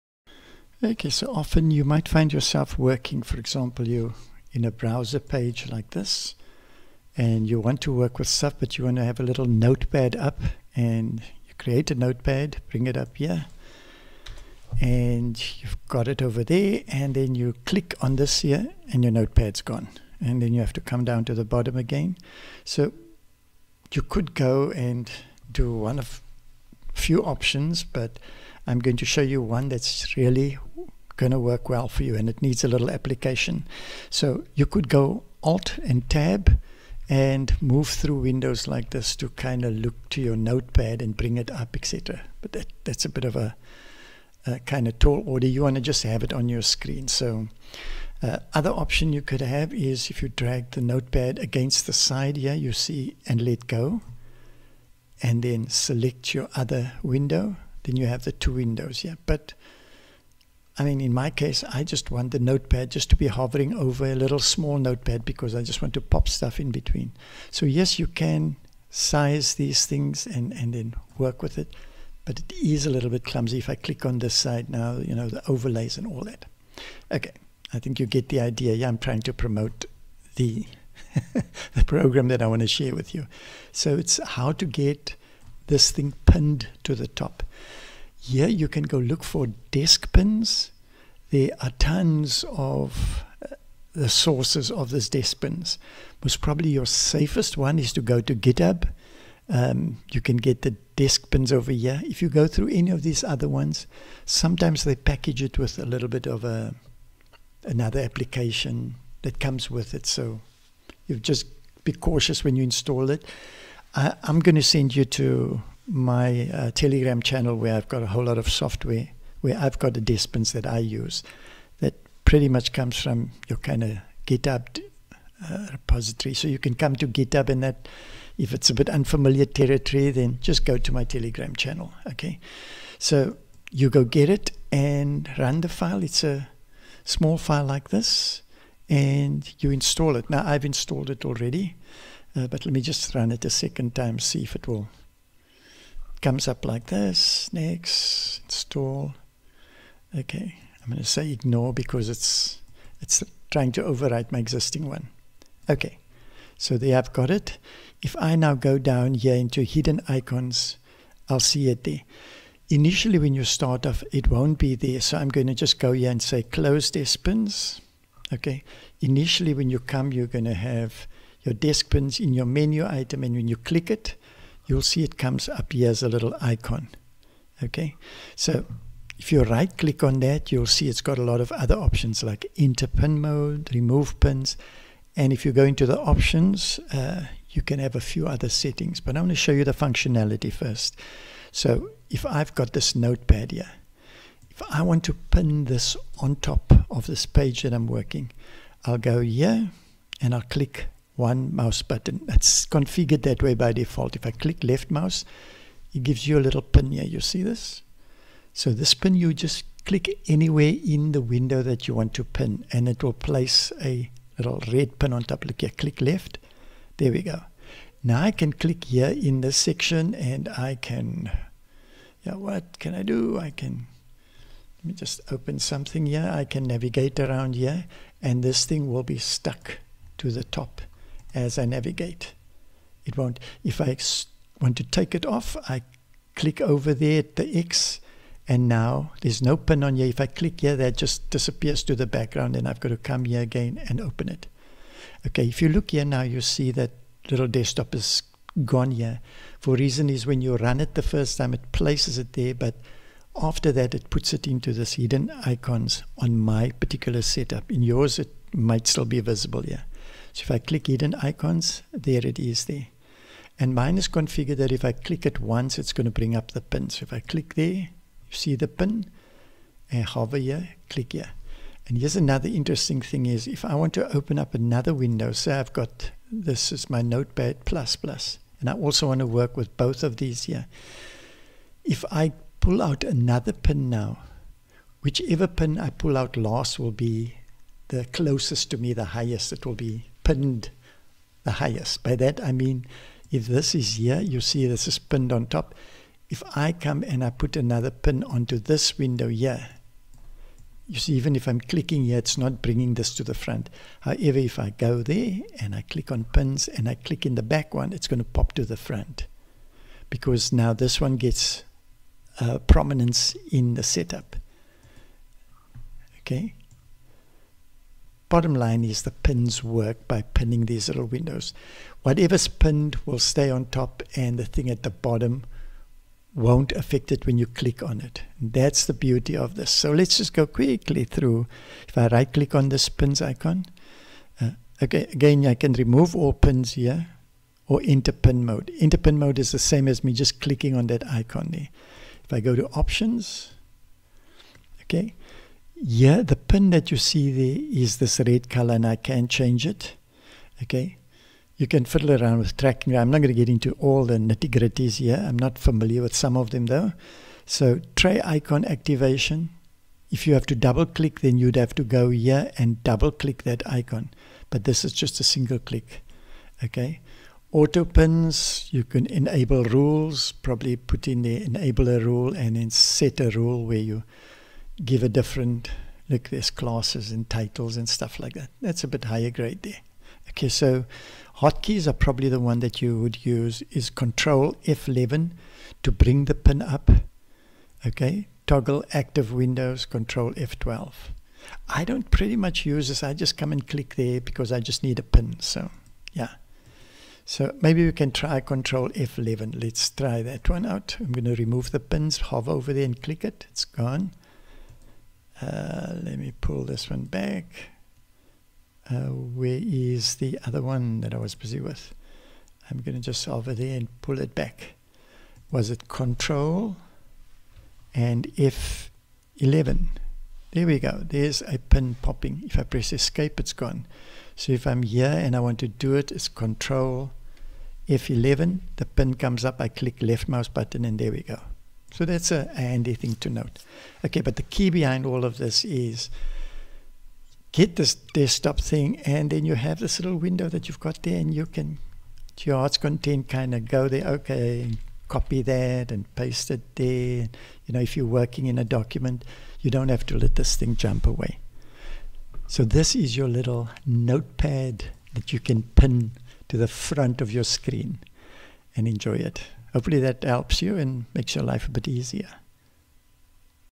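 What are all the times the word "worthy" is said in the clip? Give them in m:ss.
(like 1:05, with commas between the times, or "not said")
not said.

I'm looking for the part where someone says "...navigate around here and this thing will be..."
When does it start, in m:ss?
3:46.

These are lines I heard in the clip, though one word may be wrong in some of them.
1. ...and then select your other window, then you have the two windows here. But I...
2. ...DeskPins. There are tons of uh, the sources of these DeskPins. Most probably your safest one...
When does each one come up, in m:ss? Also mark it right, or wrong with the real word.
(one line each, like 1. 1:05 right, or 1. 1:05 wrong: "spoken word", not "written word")
1. 0:55 right
2. 1:29 right.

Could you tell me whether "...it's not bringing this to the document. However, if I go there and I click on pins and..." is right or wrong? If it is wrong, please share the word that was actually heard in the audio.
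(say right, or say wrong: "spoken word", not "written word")
wrong: "front", not "document".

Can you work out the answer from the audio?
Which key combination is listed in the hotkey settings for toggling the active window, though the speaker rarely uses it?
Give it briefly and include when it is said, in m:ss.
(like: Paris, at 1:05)
Control F12, at 6:29.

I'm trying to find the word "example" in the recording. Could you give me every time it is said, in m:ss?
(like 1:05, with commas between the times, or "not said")
0:03.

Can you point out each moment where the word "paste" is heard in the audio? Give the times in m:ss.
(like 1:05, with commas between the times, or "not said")
7:26.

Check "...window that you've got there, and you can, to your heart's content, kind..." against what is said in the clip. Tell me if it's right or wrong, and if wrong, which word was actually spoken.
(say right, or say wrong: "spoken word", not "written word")
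right.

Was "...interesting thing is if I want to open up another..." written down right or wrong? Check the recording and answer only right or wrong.
right.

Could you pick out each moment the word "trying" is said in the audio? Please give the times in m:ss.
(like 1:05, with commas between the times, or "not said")
1:18, 2:33.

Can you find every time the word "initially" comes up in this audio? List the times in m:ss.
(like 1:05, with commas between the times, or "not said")
2:42, 2:49.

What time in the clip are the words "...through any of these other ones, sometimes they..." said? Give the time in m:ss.
1:42.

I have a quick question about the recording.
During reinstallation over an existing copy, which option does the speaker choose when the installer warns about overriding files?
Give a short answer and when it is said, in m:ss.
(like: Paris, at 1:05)
Ignore, at 2:31.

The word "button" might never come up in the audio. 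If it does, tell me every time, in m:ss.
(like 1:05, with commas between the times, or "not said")
3:21, 7:10.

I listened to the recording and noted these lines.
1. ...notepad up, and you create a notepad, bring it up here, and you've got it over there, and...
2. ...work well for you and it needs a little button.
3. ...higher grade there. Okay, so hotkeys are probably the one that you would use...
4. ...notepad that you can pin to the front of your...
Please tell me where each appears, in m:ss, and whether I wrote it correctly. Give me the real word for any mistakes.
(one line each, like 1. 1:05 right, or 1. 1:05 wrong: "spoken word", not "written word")
1. 0:09 right
2. 0:31 wrong: "application", not "button"
3. 6:19 right
4. 7:33 right.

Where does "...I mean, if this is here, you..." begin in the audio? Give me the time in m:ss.
4:52.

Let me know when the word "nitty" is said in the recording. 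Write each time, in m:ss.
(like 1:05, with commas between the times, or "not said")
5:54.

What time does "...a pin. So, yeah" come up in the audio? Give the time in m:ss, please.
6:34.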